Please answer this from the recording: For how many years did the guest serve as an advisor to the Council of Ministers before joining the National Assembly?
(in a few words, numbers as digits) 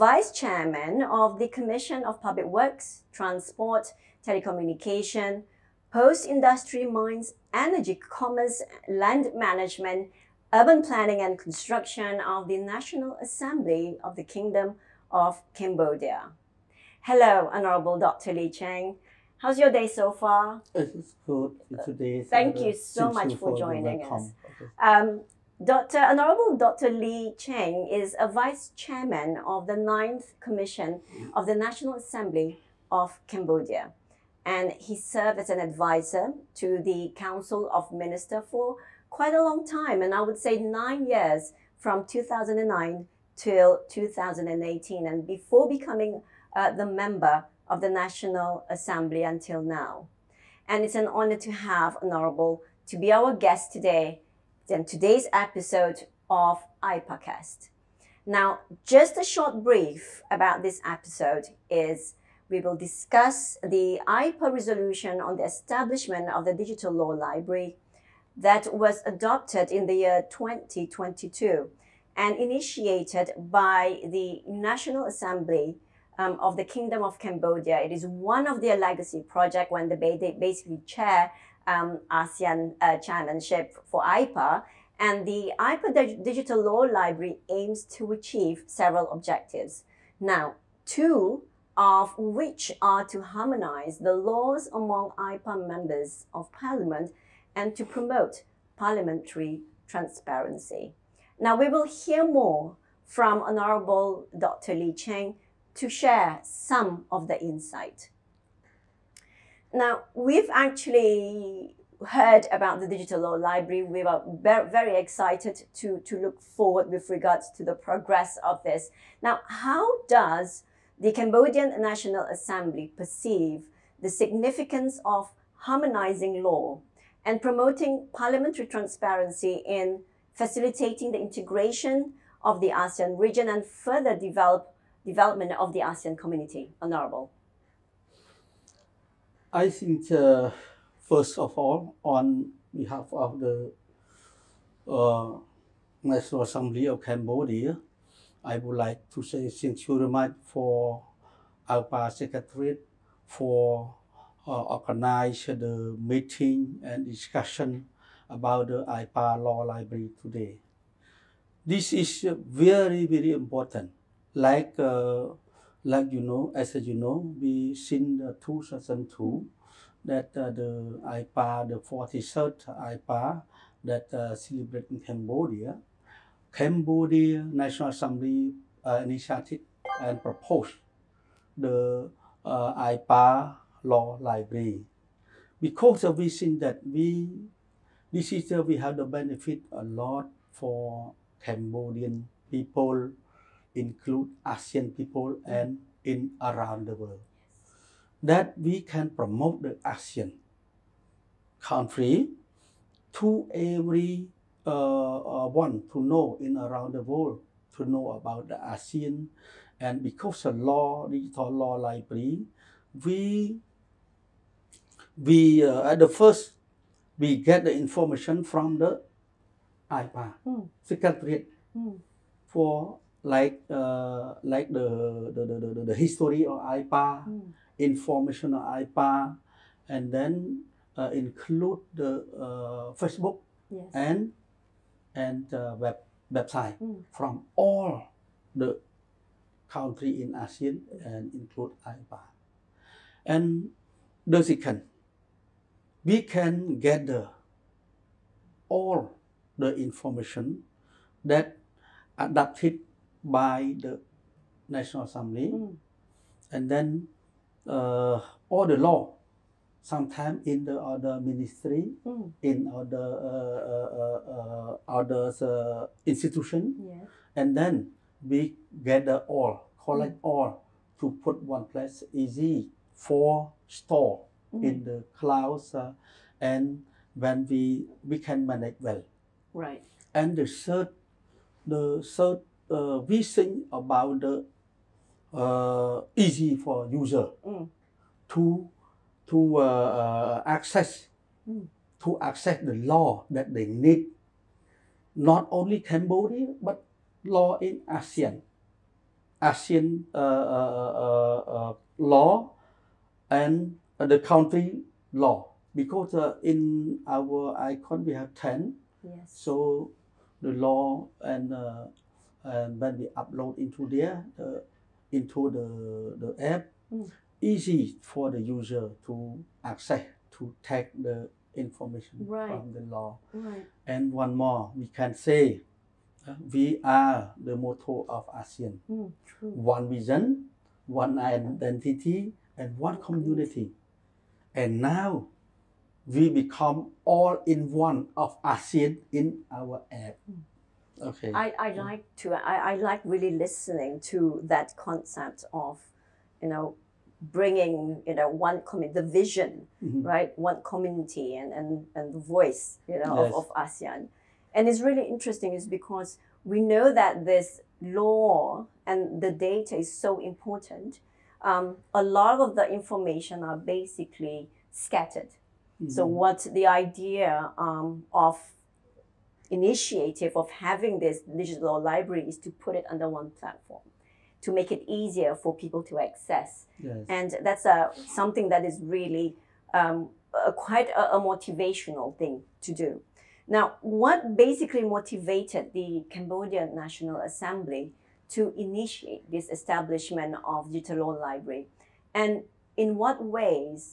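9.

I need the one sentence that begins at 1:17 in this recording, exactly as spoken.
It is one of their legacy projects when they basically chair um, ASEAN uh, chairmanship for AIPA.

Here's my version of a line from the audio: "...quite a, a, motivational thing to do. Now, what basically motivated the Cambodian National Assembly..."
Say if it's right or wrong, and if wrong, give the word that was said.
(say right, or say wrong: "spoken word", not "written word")
right.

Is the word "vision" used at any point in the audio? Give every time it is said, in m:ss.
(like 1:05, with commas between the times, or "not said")
5:29, 5:49.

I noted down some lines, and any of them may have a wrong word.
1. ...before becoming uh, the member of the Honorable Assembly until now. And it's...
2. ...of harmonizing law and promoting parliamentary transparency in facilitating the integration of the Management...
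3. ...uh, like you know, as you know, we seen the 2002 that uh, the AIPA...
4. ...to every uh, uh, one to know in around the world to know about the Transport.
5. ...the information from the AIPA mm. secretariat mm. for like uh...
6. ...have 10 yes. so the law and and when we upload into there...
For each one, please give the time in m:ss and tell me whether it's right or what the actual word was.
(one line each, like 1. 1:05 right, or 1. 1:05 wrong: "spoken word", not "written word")
1. 0:45 wrong: "National", not "Honorable"
2. 2:05 wrong: "ASEAN", not "Management"
3. 2:44 right
4. 3:23 wrong: "ASEAN", not "Transport"
5. 3:37 right
6. 5:08 right.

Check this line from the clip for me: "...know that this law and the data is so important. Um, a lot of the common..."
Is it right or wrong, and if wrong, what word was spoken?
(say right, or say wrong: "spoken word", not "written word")
wrong: "information", not "common".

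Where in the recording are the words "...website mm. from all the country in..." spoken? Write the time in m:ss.
3:56.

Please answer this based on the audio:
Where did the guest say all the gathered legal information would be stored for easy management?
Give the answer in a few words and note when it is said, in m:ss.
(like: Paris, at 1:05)
In the clouds, at 4:34.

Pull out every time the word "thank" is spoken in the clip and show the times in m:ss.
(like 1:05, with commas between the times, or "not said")
0:22, 2:29.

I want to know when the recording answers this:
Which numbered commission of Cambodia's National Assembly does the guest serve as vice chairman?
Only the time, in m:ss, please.
0:29.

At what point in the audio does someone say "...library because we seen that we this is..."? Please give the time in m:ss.
3:04.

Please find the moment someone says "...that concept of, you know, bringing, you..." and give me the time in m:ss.
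5:44.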